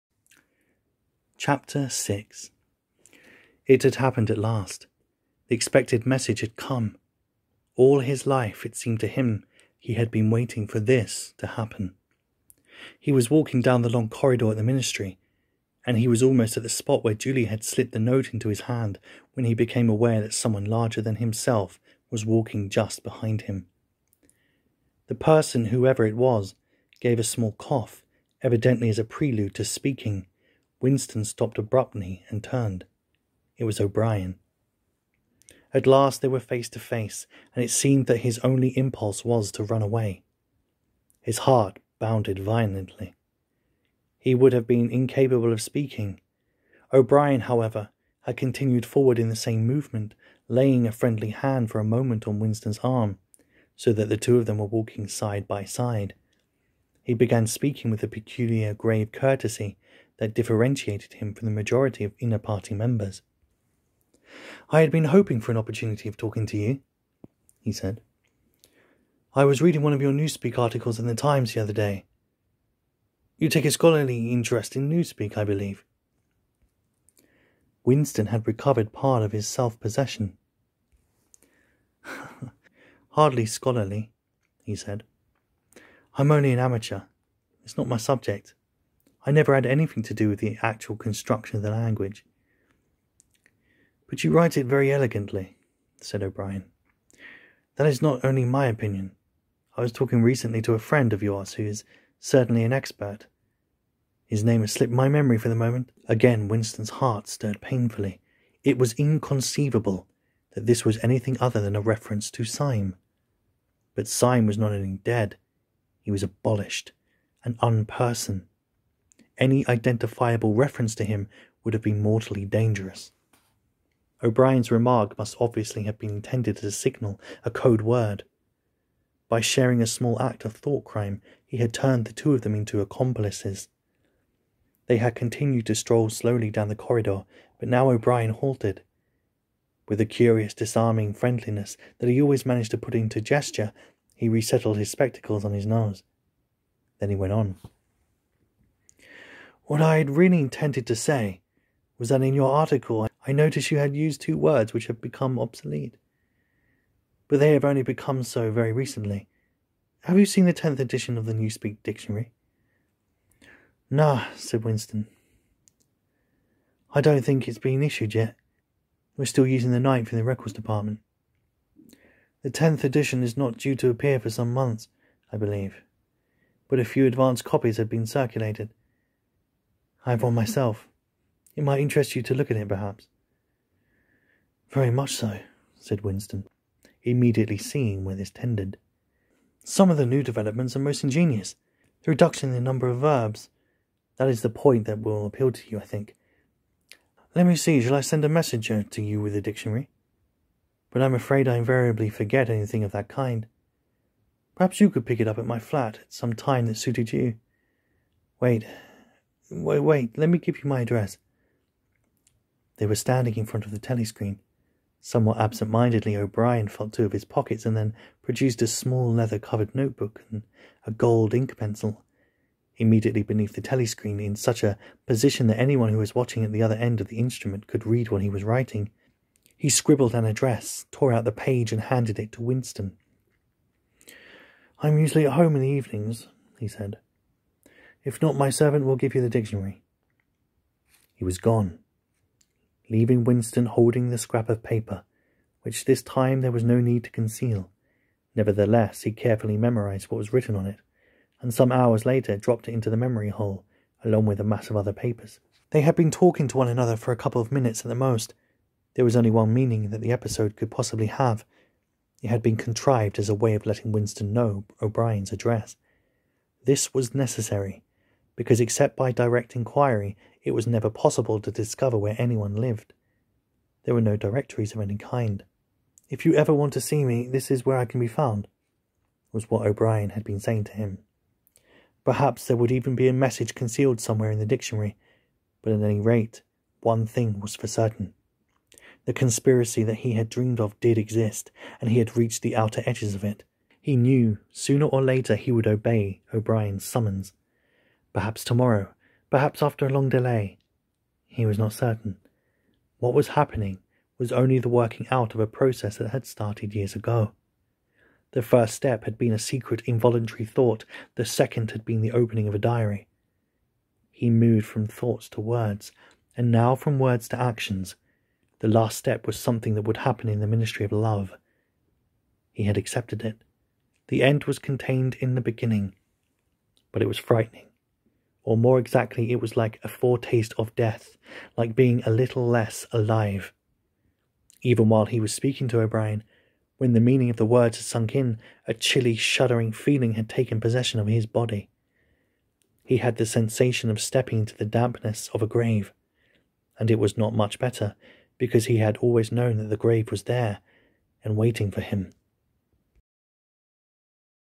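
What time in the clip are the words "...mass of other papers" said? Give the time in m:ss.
4:14.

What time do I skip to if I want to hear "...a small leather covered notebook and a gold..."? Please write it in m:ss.
3:38.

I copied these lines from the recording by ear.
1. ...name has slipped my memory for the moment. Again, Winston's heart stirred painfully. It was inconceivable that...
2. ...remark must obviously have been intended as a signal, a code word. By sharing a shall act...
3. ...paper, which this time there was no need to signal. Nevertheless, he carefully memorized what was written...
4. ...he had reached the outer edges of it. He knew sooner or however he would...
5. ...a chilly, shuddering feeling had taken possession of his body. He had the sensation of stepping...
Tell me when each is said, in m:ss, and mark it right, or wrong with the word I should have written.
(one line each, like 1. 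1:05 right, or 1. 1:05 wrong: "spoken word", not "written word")
1. 1:44 right
2. 2:04 wrong: "small", not "shall"
3. 4:04 wrong: "conceal", not "signal"
4. 4:51 wrong: "later", not "however"
5. 5:38 right.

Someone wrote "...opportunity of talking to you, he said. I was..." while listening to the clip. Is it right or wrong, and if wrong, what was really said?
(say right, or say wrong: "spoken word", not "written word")
right.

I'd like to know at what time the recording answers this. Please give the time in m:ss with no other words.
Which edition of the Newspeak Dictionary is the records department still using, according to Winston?
2:49.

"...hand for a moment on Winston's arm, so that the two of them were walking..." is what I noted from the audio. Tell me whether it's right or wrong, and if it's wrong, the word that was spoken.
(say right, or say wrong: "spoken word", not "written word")
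right.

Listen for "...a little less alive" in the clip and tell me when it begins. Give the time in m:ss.
5:32.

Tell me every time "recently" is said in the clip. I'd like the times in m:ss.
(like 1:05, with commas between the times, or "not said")
1:40, 2:38.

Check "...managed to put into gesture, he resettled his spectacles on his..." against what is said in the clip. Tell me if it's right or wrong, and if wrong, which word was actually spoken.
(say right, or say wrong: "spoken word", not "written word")
right.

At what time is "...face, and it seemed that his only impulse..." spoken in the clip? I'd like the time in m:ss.
0:36.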